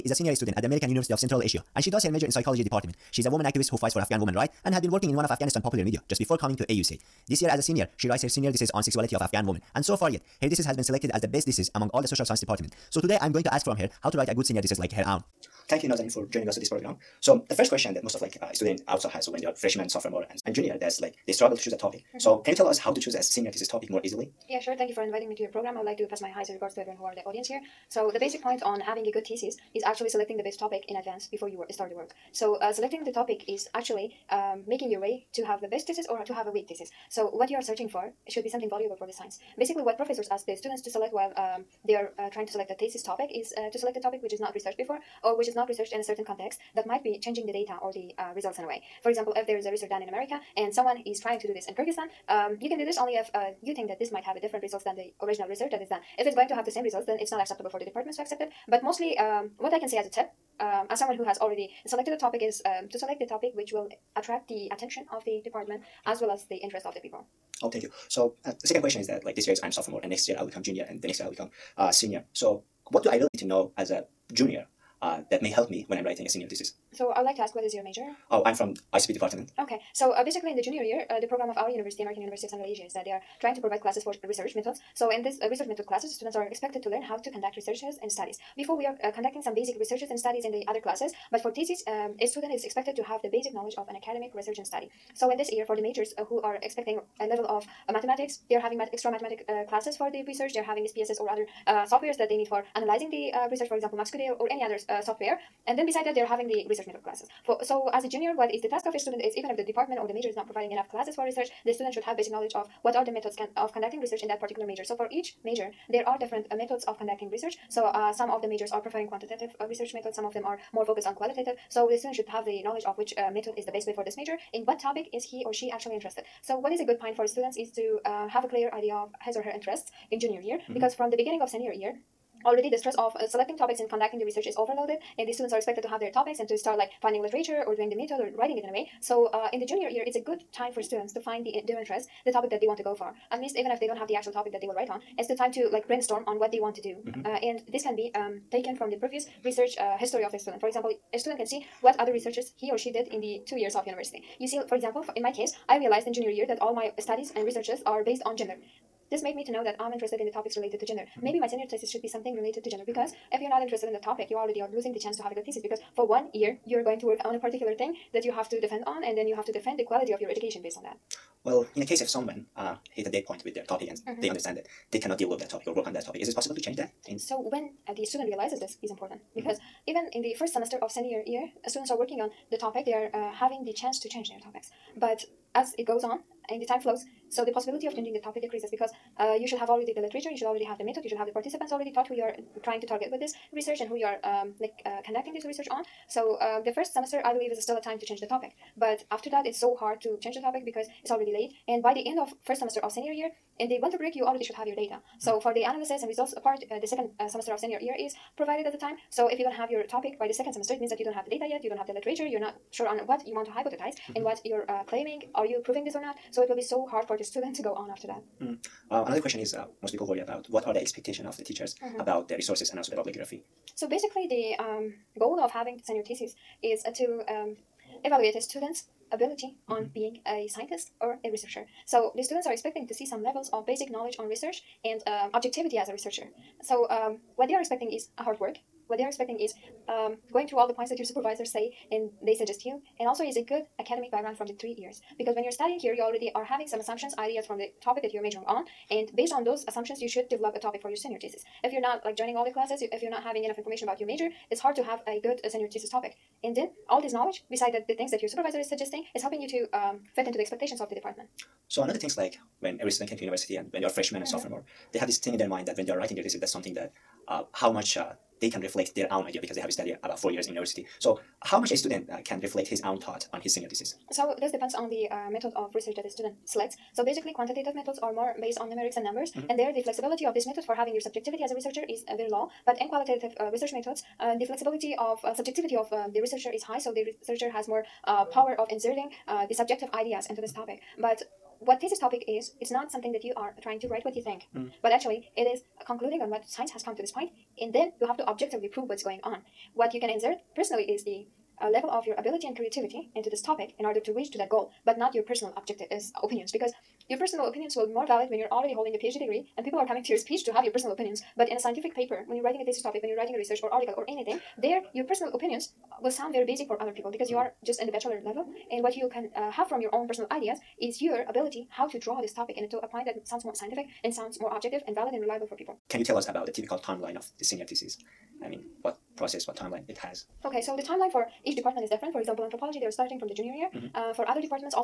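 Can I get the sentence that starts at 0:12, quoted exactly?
So today I'm going to ask from her how to write a good senior thesis like her own.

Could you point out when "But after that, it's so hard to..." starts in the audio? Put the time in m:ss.
3:18.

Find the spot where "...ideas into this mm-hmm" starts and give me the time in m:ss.
4:49.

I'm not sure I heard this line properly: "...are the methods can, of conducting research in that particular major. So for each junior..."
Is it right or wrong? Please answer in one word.
wrong.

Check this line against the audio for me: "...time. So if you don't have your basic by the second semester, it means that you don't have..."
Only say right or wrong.
wrong.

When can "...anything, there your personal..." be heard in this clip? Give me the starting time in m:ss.
5:14.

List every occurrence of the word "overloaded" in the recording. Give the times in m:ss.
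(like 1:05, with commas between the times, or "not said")
2:14.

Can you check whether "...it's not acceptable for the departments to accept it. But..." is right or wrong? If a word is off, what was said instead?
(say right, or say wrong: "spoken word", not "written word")
right.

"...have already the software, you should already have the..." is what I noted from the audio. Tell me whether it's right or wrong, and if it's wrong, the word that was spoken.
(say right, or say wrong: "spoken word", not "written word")
wrong: "literature", not "software".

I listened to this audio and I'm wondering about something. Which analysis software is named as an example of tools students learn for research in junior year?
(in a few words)
MaxQDA.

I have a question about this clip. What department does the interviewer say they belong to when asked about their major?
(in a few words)
ICP.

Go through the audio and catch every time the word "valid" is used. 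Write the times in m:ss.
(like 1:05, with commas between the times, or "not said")
5:08, 5:24.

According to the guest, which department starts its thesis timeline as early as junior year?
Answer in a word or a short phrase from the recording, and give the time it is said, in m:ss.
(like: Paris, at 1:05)
anthropology, at 5:32.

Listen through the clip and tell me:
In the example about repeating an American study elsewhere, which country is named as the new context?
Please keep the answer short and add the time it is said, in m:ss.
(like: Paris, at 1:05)
Kyrgyzstan, at 0:51.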